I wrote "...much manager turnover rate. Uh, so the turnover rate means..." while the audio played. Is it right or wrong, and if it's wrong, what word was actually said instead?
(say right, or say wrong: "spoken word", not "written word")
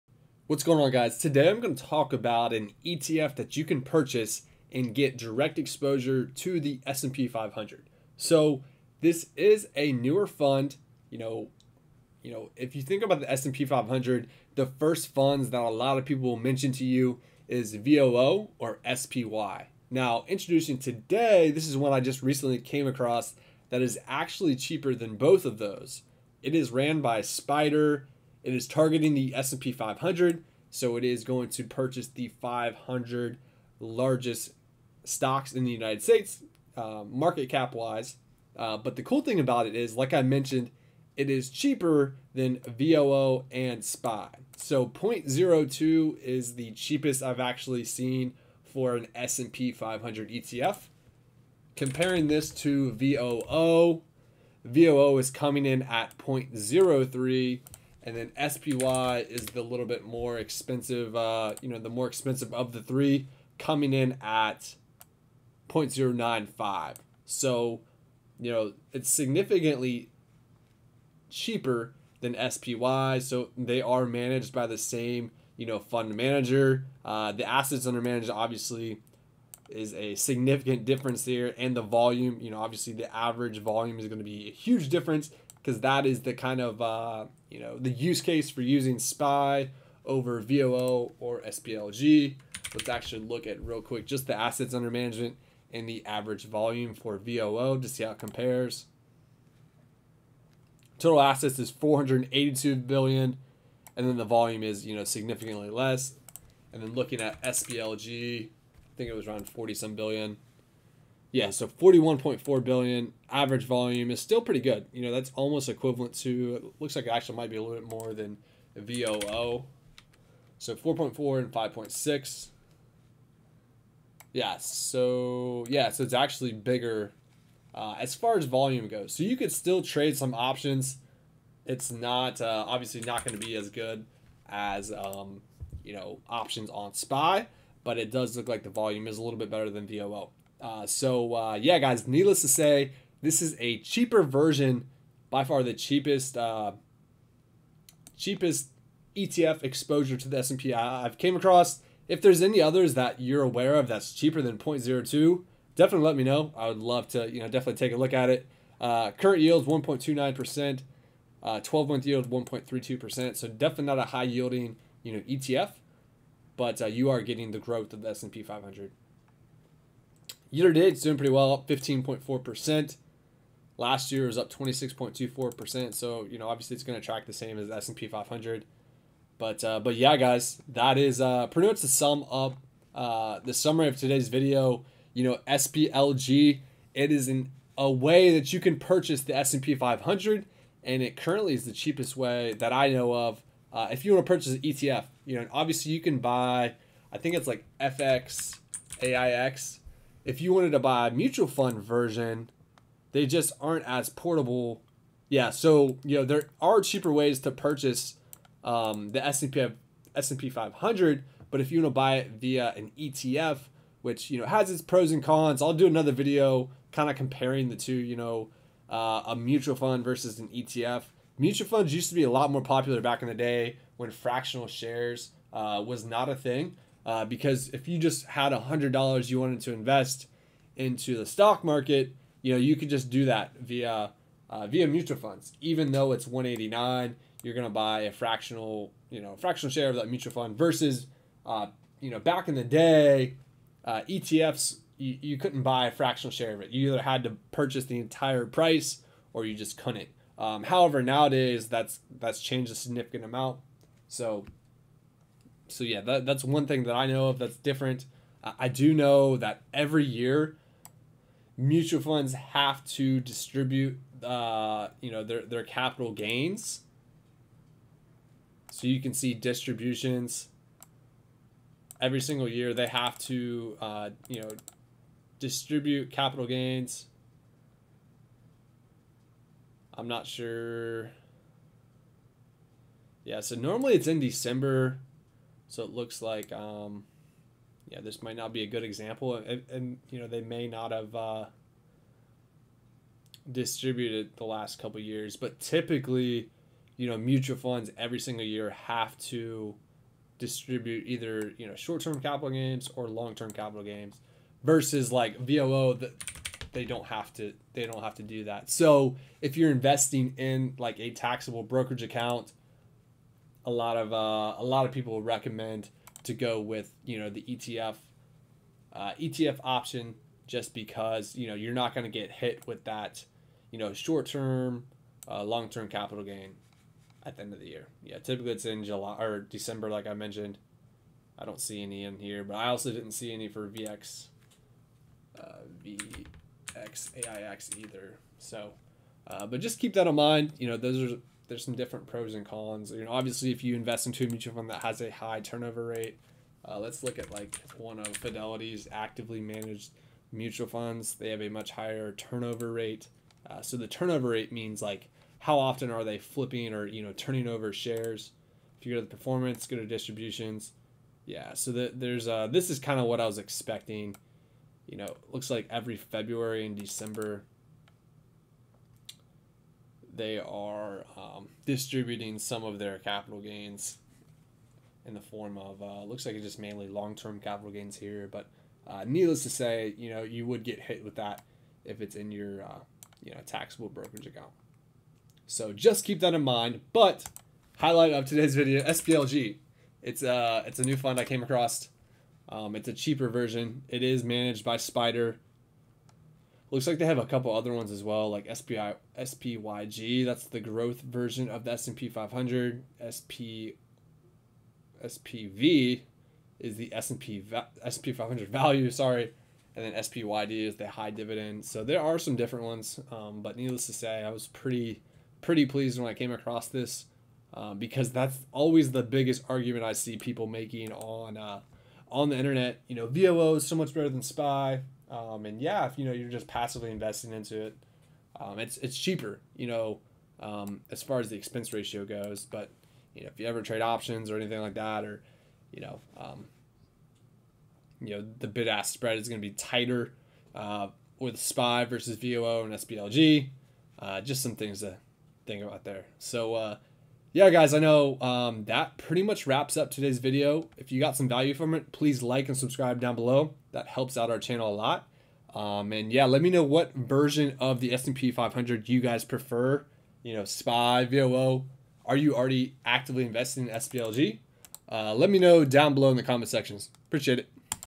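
wrong: "higher", not "manager".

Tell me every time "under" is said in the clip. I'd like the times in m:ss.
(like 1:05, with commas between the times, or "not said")
1:17, 1:34.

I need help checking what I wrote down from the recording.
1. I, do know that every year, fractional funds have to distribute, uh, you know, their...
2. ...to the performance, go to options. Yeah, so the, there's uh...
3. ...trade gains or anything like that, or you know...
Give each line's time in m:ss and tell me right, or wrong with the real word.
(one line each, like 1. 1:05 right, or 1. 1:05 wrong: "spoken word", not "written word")
1. 4:18 wrong: "mutual", not "fractional"
2. 5:59 wrong: "distributions", not "options"
3. 7:13 wrong: "options", not "gains".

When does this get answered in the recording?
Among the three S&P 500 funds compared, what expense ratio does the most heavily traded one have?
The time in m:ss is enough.
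1:05.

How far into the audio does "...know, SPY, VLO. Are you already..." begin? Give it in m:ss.
7:40.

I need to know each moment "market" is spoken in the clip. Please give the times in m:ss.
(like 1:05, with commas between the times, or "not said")
0:37, 3:51.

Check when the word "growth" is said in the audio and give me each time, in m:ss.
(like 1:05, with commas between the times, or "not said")
2:47, 6:40.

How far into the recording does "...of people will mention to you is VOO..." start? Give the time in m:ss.
0:15.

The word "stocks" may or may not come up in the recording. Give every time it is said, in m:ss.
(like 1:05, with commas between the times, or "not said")
0:35, 3:51.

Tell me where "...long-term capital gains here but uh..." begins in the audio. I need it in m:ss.
6:16.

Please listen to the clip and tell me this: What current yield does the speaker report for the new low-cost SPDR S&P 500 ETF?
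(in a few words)
1.29%.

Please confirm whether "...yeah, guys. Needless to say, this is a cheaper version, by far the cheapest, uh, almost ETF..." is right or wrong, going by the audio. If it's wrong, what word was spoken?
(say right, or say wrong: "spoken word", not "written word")
wrong: "cheapest", not "almost".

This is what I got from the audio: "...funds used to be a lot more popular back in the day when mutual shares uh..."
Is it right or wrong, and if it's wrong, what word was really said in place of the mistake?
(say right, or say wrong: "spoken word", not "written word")
wrong: "fractional", not "mutual".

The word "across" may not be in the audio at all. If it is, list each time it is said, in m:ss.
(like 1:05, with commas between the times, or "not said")
0:22, 2:31, 6:31, 6:56.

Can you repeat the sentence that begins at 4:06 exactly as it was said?
You either had to purchase the entire price or you just couldn't.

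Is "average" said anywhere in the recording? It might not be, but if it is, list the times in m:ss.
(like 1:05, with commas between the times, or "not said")
1:23, 1:36, 1:53.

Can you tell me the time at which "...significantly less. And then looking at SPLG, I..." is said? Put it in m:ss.
1:45.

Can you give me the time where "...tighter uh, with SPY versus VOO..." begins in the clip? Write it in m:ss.
7:19.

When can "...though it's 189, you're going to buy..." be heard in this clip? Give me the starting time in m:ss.
3:55.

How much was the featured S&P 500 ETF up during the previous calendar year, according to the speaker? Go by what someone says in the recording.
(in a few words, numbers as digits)
26.24%.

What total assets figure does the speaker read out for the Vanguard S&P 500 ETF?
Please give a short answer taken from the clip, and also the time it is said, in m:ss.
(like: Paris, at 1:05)
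482 billion, at 1:41.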